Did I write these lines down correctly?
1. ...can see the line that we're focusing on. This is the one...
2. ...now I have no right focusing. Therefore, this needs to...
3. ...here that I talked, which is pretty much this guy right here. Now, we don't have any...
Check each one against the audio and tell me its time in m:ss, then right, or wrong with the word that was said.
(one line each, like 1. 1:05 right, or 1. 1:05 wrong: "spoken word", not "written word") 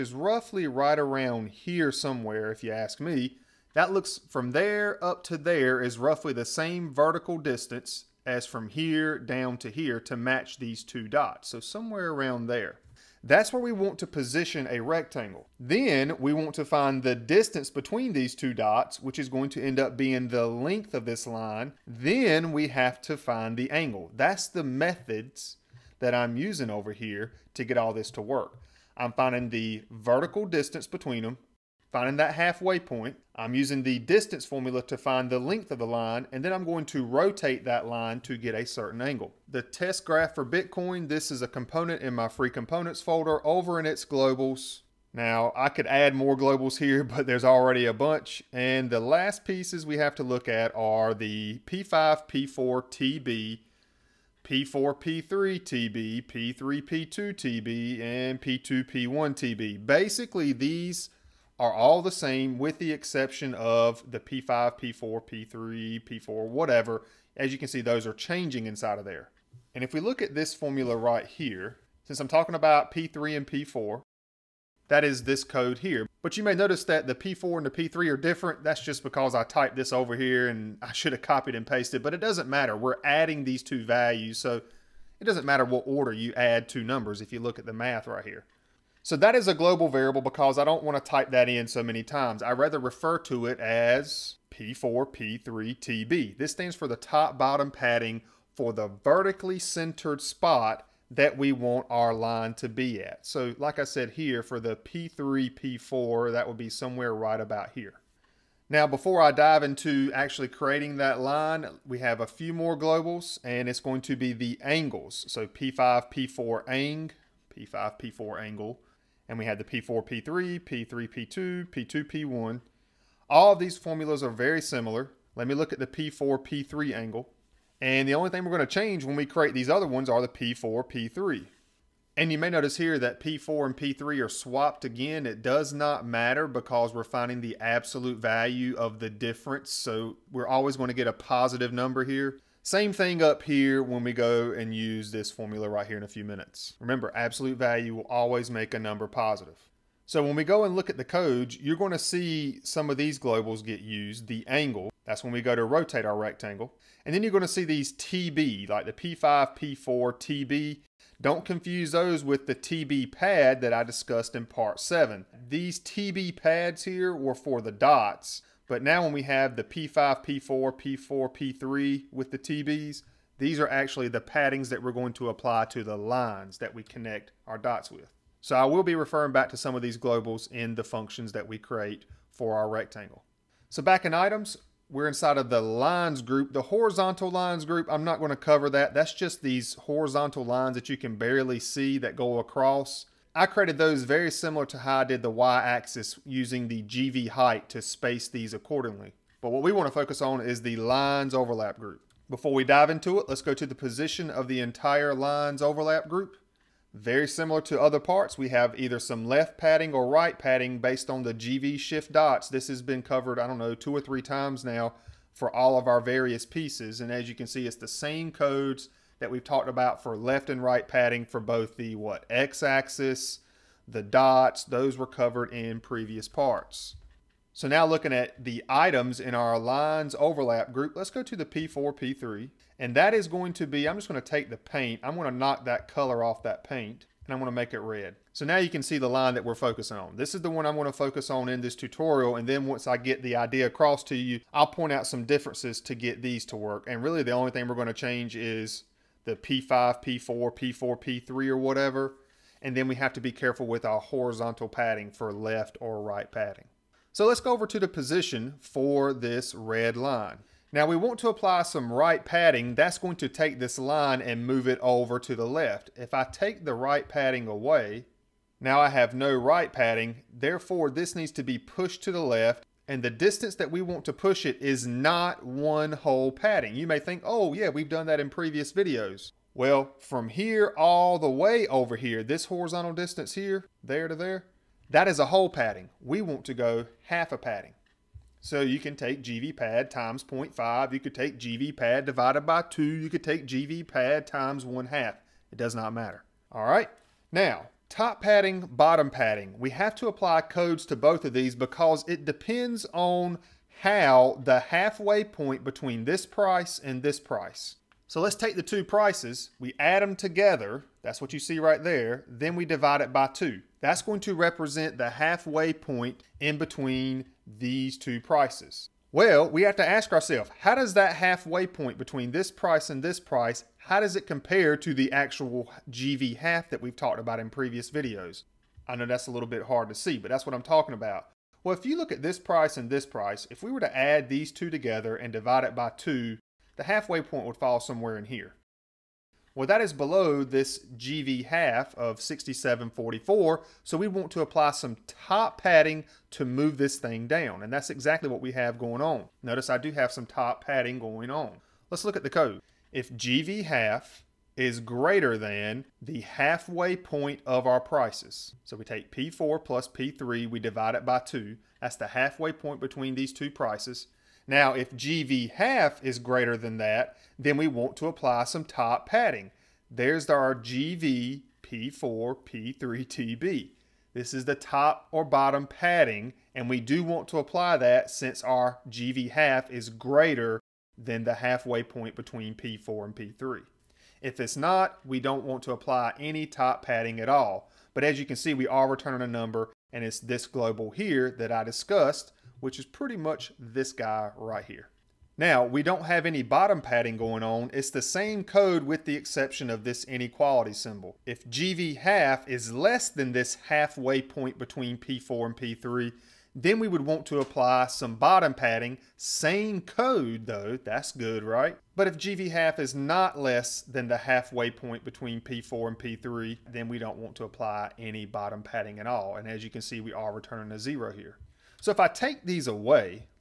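1. 3:58 right
2. 4:28 wrong: "padding", not "focusing"
3. 6:30 wrong: "discussed", not "talked".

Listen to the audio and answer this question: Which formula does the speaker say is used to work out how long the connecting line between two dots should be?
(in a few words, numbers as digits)
distance formula.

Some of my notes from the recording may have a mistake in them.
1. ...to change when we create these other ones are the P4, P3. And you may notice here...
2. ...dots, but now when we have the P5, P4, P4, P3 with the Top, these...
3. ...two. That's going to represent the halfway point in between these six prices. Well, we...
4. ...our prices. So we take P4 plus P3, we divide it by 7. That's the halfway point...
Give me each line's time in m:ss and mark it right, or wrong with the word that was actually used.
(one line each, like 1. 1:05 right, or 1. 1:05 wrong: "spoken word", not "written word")
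1. 2:08 right
2. 2:47 wrong: "TBs", not "Top"
3. 5:13 wrong: "two", not "six"
4. 5:57 wrong: "2", not "7".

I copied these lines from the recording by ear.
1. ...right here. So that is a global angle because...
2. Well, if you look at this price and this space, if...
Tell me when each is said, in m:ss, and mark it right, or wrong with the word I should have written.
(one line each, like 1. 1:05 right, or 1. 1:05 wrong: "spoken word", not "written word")
1. 1:28 wrong: "variable", not "angle"
2. 5:31 wrong: "price", not "space".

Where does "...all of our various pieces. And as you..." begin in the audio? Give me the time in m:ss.
3:35.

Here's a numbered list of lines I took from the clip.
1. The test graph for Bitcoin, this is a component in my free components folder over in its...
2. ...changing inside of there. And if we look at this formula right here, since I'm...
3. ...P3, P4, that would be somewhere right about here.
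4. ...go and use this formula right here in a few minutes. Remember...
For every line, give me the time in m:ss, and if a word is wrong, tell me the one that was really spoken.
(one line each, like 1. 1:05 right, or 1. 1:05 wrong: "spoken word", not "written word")
1. 0:39 right
2. 1:08 right
3. 1:44 right
4. 2:24 right.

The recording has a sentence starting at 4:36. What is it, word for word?
You may think, oh yeah, we've done that in previous videos.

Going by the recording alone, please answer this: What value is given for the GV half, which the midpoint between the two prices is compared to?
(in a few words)
6744.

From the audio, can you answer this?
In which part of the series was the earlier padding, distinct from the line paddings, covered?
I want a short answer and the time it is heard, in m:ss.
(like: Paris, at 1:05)
part 7, at 2:44.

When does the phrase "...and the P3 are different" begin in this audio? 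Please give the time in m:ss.
1:17.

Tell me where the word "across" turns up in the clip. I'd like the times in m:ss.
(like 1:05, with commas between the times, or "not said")
3:12, 4:03.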